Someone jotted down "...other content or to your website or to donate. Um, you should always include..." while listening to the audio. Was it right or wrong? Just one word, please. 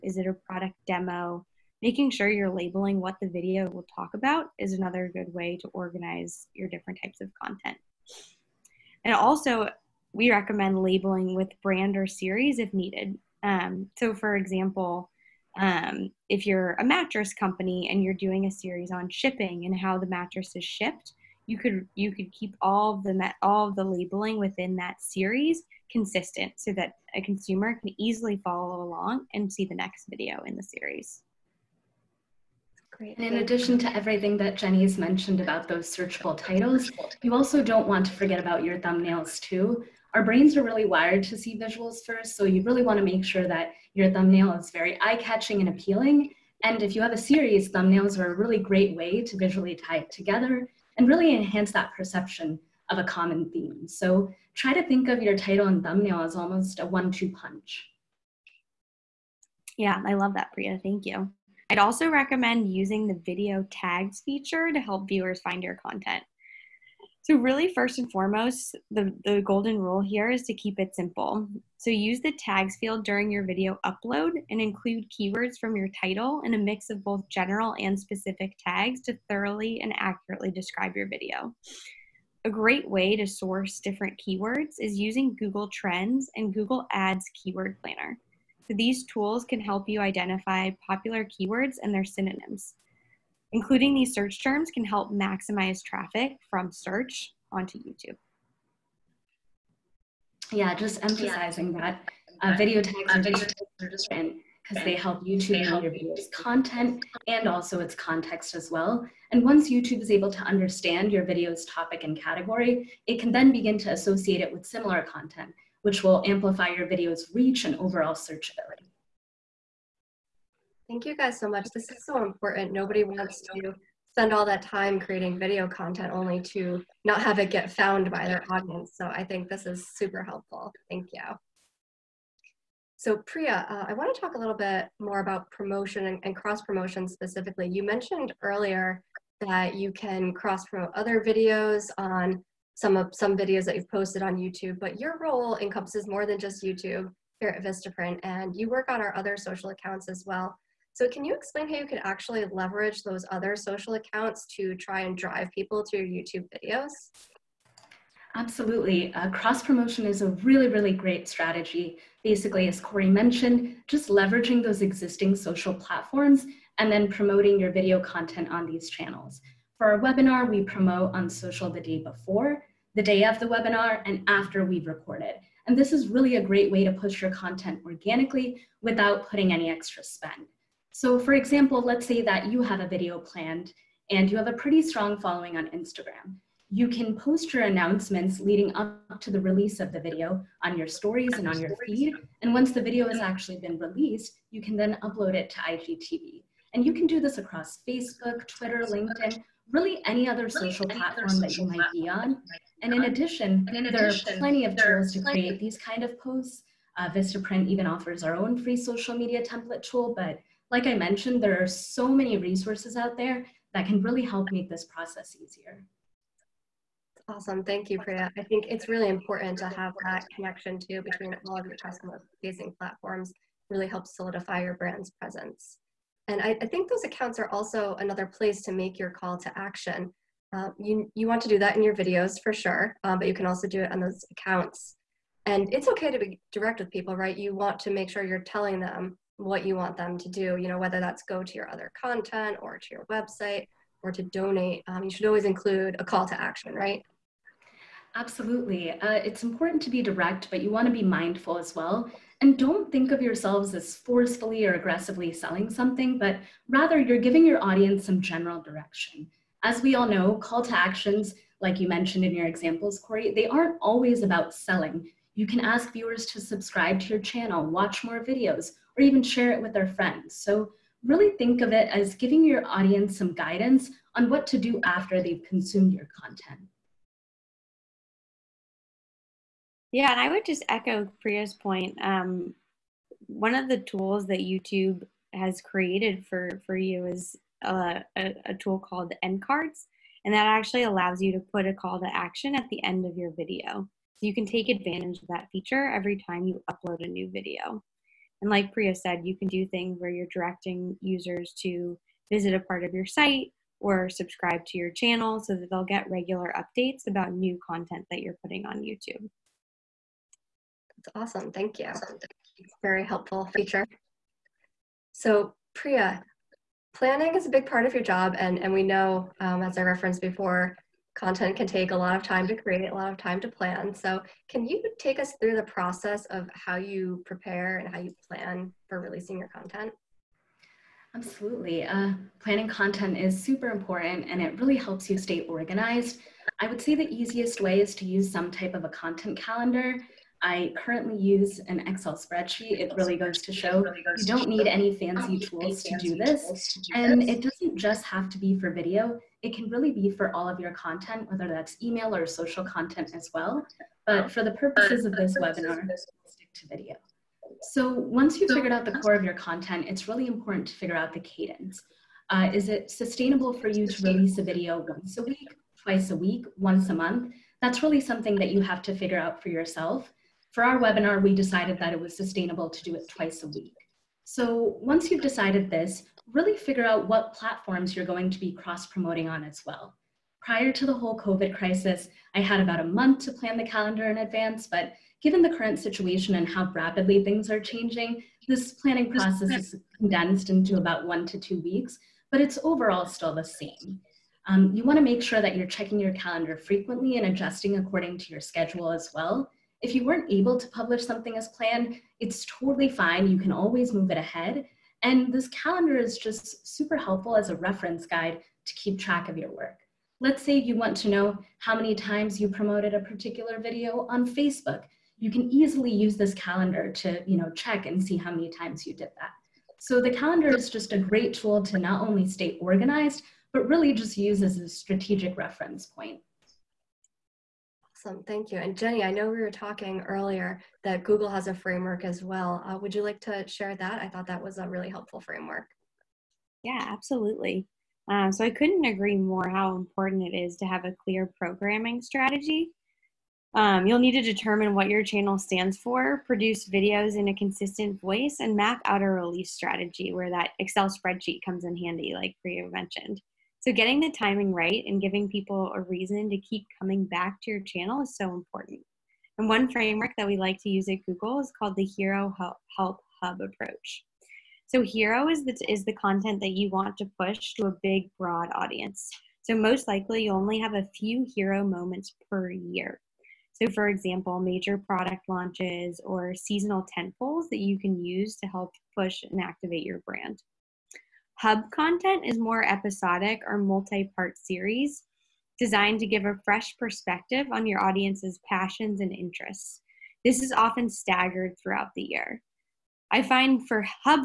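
right.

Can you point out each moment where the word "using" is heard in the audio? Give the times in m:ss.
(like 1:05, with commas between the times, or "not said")
1:02, 1:24.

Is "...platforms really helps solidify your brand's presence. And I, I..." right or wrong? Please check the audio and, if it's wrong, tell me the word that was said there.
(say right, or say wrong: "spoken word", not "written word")
right.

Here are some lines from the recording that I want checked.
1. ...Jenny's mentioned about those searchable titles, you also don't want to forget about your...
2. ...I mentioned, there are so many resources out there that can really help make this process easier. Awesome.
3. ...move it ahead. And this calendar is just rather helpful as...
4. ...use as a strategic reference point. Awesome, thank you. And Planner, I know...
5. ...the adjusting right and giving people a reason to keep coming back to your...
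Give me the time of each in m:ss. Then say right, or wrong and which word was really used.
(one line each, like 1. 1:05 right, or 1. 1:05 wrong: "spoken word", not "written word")
1. 0:34 right
2. 3:30 right
3. 6:43 wrong: "super", not "rather"
4. 7:04 wrong: "Jenny", not "Planner"
5. 7:33 wrong: "timing", not "adjusting".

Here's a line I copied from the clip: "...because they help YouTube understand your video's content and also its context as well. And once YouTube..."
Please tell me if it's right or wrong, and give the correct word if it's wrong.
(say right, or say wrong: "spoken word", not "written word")
right.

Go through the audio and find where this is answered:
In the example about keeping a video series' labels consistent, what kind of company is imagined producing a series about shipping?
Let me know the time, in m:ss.
0:16.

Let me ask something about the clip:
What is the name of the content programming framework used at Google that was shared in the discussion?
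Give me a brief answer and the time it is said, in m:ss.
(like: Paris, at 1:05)
Hero Help Hub, at 7:41.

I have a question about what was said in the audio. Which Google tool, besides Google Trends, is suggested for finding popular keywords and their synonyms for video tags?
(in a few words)
Google Ads Keyword Planner.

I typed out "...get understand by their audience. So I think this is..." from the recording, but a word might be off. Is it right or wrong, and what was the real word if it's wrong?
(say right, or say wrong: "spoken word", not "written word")
wrong: "found", not "understand".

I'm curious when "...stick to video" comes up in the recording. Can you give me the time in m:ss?
5:56.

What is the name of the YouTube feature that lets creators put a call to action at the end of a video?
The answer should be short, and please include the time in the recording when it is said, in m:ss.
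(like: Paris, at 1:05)
End cards, at 4:49.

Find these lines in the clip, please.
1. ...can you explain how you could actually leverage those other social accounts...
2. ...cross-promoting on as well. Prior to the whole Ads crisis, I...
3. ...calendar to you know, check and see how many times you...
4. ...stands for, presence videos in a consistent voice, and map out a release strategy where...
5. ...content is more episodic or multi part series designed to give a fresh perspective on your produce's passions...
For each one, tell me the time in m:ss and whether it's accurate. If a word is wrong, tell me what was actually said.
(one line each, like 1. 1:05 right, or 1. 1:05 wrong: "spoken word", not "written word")
1. 2:31 right
2. 6:18 wrong: "COVID", not "Ads"
3. 6:56 right
4. 7:25 wrong: "produce", not "presence"
5. 8:01 wrong: "audience", not "produce".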